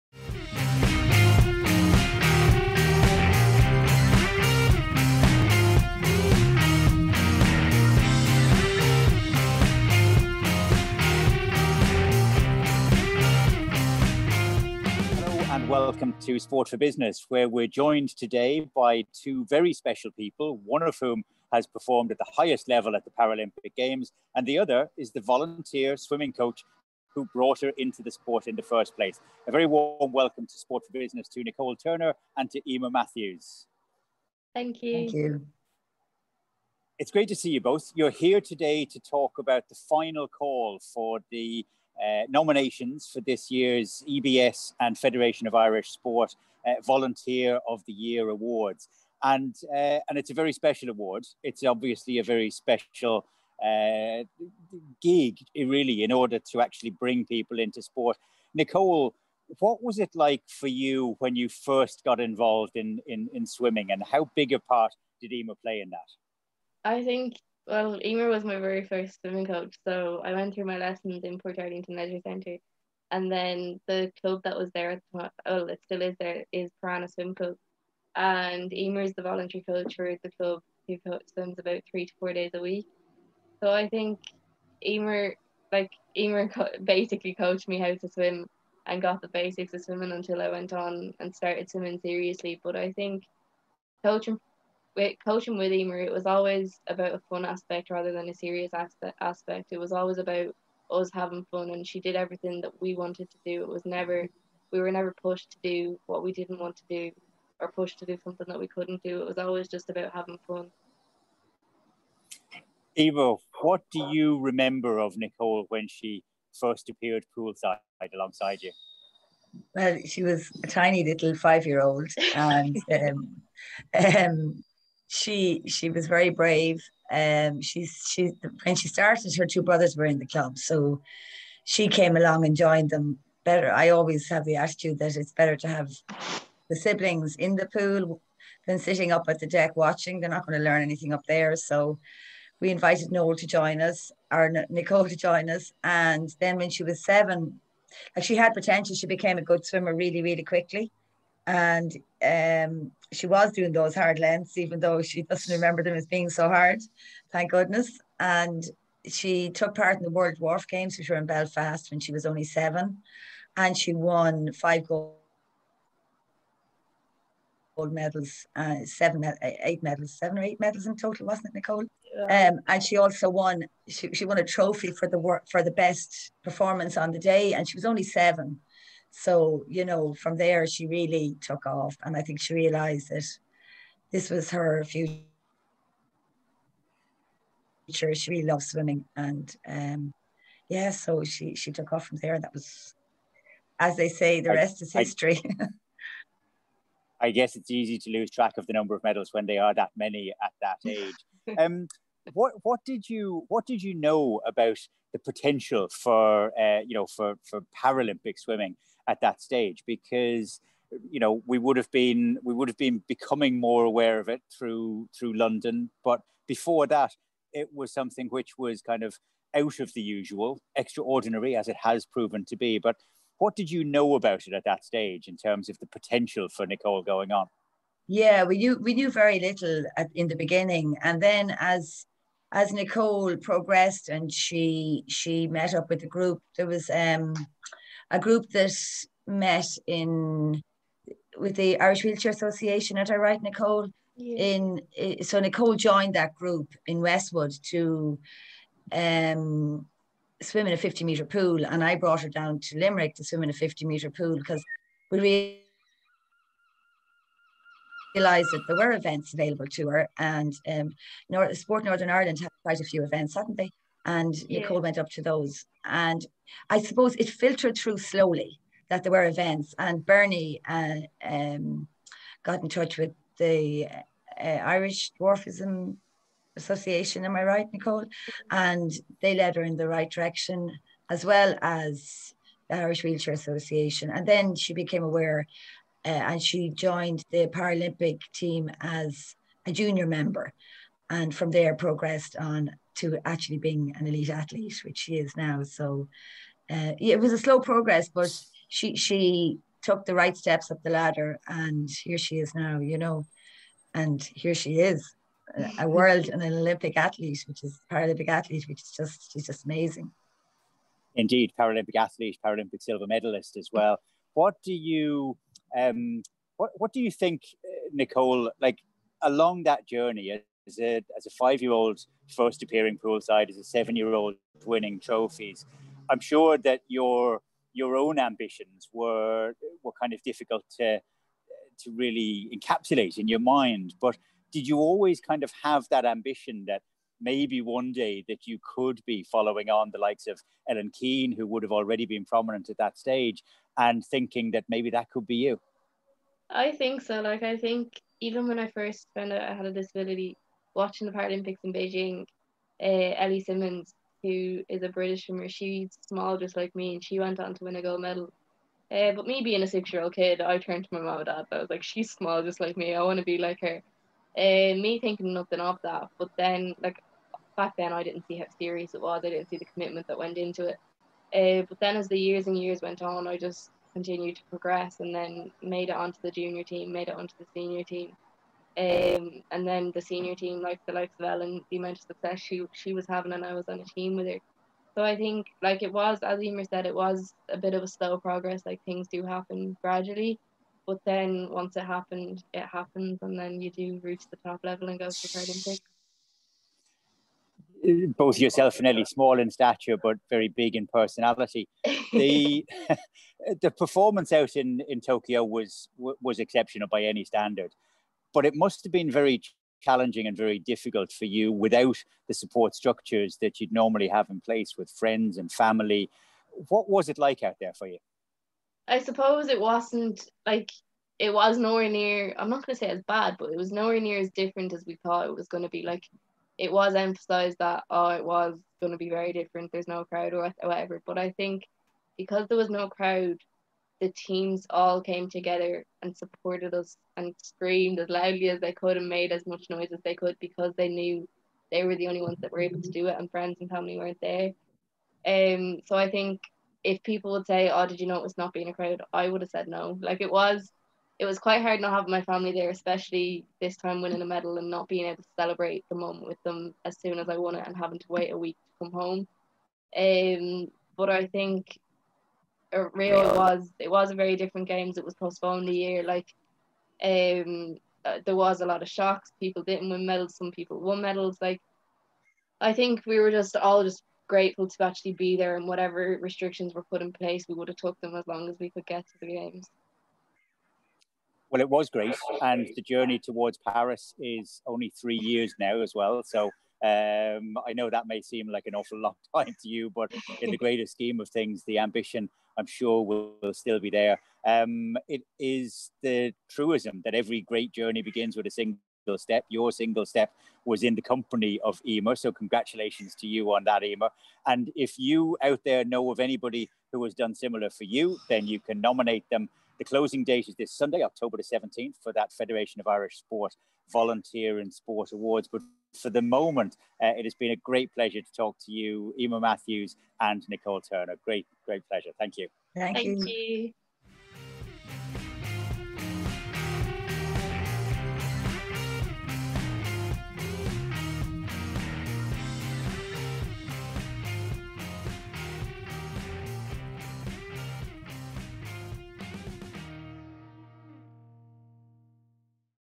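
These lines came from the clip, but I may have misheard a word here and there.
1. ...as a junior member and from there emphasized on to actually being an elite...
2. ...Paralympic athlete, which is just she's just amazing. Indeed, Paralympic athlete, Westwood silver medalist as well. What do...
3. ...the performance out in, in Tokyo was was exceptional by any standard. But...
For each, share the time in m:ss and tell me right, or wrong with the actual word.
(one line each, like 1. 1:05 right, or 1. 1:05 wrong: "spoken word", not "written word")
1. 4:48 wrong: "progressed", not "emphasized"
2. 5:07 wrong: "Paralympic", not "Westwood"
3. 6:43 right.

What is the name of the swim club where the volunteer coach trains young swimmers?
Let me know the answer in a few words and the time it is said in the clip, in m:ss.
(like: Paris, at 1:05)
Piranha Swim Club, at 1:16.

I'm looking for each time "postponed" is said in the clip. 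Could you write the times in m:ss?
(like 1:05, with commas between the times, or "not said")
7:45.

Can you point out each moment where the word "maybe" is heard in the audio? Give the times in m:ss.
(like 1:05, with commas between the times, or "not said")
5:37, 5:44.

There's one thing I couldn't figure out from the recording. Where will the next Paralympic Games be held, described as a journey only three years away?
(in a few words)
Paris.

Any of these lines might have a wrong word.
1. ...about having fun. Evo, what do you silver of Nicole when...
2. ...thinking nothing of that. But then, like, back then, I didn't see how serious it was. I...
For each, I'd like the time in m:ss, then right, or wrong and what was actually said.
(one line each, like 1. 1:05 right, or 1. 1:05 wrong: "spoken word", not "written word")
1. 1:49 wrong: "remember", not "silver"
2. 6:05 right.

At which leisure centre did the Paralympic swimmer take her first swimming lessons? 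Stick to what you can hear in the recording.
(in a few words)
Portarlington Leisure Centre.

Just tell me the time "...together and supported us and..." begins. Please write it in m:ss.
7:15.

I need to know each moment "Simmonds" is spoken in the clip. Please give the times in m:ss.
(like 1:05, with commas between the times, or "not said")
5:53.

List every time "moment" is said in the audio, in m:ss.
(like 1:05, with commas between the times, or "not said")
7:35, 8:36.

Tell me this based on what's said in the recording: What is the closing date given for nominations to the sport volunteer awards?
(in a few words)
October 17th.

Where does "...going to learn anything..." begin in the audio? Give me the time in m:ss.
2:20.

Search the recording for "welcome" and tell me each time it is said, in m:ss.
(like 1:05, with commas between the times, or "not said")
0:16, 0:30.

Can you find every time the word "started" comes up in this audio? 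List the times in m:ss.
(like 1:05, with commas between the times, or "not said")
1:31, 2:08.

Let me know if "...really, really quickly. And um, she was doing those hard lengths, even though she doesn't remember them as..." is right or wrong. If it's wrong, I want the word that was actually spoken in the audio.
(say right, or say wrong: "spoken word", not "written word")
right.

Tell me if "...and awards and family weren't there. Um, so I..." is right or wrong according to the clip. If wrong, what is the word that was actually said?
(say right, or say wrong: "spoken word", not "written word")
wrong: "friends", not "awards".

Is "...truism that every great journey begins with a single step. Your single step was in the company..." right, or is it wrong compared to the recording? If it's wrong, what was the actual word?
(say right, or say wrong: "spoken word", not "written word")
right.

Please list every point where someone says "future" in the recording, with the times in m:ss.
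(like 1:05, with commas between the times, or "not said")
3:04.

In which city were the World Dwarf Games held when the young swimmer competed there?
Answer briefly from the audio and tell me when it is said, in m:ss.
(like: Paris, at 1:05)
Belfast, at 2:41.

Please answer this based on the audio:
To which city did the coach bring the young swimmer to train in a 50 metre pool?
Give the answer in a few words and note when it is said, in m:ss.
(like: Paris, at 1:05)
Limerick, at 4:12.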